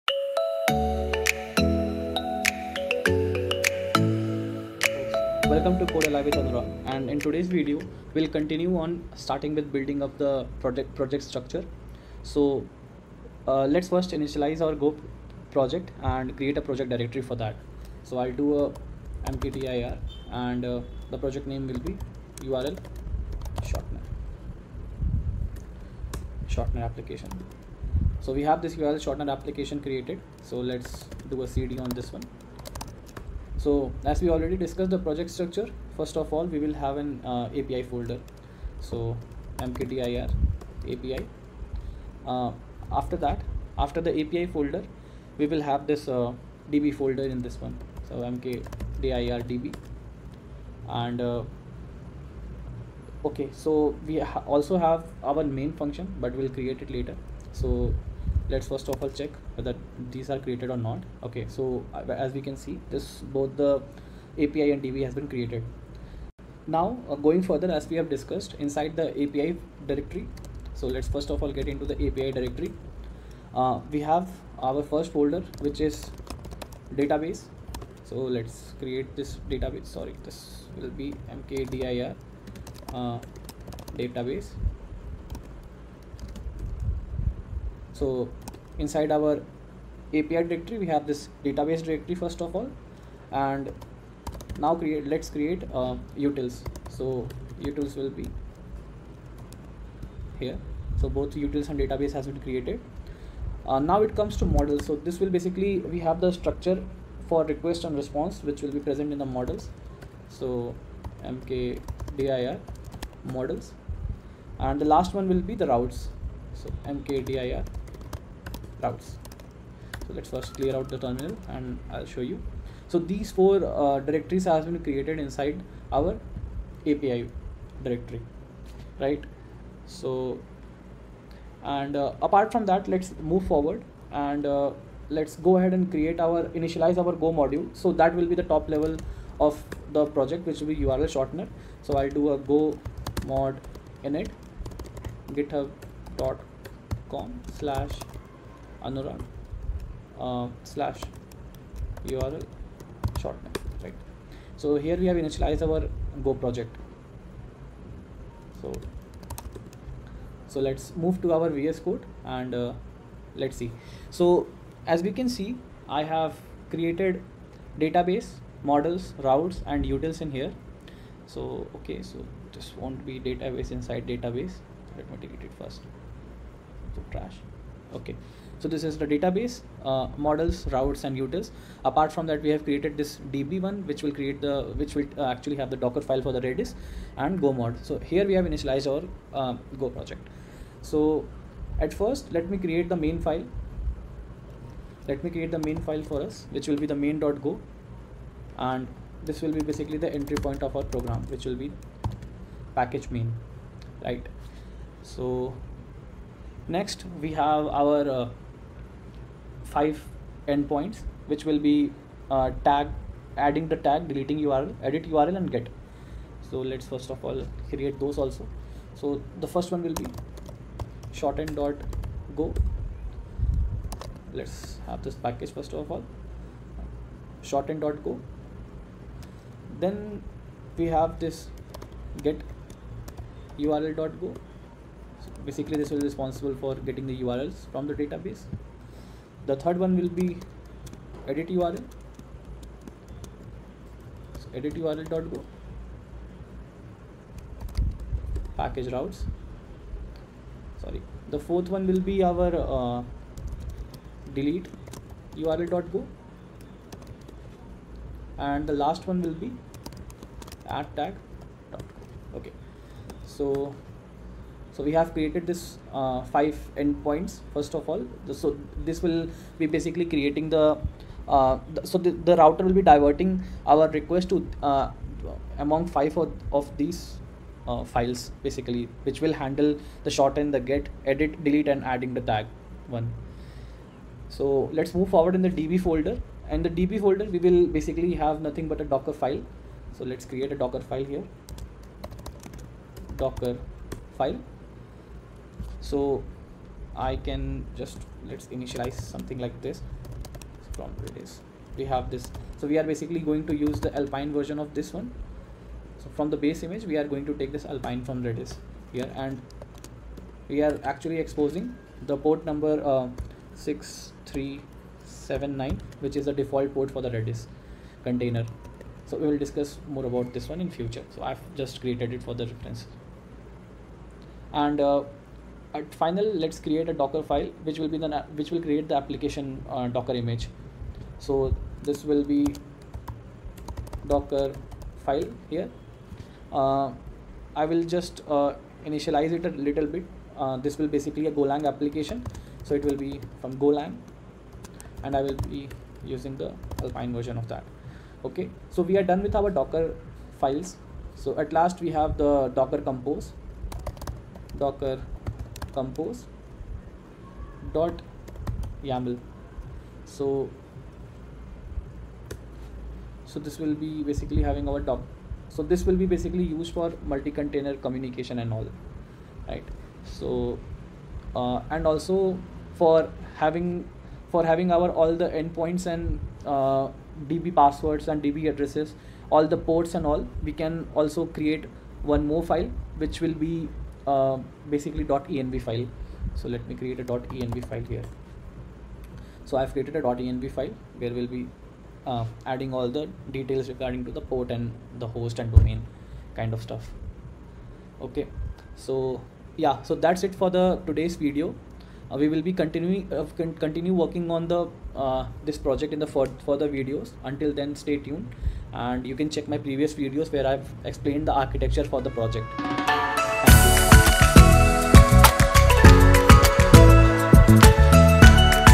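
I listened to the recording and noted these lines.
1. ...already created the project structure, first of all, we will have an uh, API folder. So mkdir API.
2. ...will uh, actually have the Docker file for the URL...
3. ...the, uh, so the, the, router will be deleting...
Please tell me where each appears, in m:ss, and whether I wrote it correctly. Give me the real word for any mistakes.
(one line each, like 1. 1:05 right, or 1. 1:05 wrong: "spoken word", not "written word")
1. 0:34 wrong: "discussed", not "created"
2. 3:04 wrong: "Redis", not "URL"
3. 4:30 wrong: "diverting", not "deleting".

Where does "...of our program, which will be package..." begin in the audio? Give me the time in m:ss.
3:20.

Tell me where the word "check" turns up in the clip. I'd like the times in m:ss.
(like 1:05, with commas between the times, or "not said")
0:59, 6:49.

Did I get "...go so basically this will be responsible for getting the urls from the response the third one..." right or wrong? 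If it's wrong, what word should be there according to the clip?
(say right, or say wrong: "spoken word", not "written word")
wrong: "database", not "response".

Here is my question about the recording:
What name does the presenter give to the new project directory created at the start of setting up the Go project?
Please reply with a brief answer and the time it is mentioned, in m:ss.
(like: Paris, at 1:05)
URL shortener application, at 0:22.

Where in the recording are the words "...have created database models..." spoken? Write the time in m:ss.
2:46.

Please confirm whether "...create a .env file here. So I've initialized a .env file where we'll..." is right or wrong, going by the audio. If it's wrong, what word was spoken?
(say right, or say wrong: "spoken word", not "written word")
wrong: "created", not "initialized".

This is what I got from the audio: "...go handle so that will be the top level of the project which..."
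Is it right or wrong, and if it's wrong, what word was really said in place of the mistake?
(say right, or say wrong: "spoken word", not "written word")
wrong: "module", not "handle".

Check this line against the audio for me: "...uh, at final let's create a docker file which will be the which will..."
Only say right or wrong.
right.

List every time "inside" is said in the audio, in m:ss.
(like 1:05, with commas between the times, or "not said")
1:08, 1:28, 2:05, 2:53.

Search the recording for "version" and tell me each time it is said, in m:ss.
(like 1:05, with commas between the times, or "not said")
5:04, 5:47.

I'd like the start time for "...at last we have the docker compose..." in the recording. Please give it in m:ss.
5:51.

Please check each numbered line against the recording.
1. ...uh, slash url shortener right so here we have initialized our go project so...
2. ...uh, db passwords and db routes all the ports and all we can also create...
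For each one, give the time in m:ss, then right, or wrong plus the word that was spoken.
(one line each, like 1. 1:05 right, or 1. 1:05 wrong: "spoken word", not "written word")
1. 2:30 right
2. 6:16 wrong: "addresses", not "routes".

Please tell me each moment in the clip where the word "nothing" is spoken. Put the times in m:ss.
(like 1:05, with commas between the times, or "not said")
4:48.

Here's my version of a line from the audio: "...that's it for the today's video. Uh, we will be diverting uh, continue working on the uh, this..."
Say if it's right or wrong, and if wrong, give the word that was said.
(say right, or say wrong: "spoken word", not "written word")
wrong: "continuing", not "diverting".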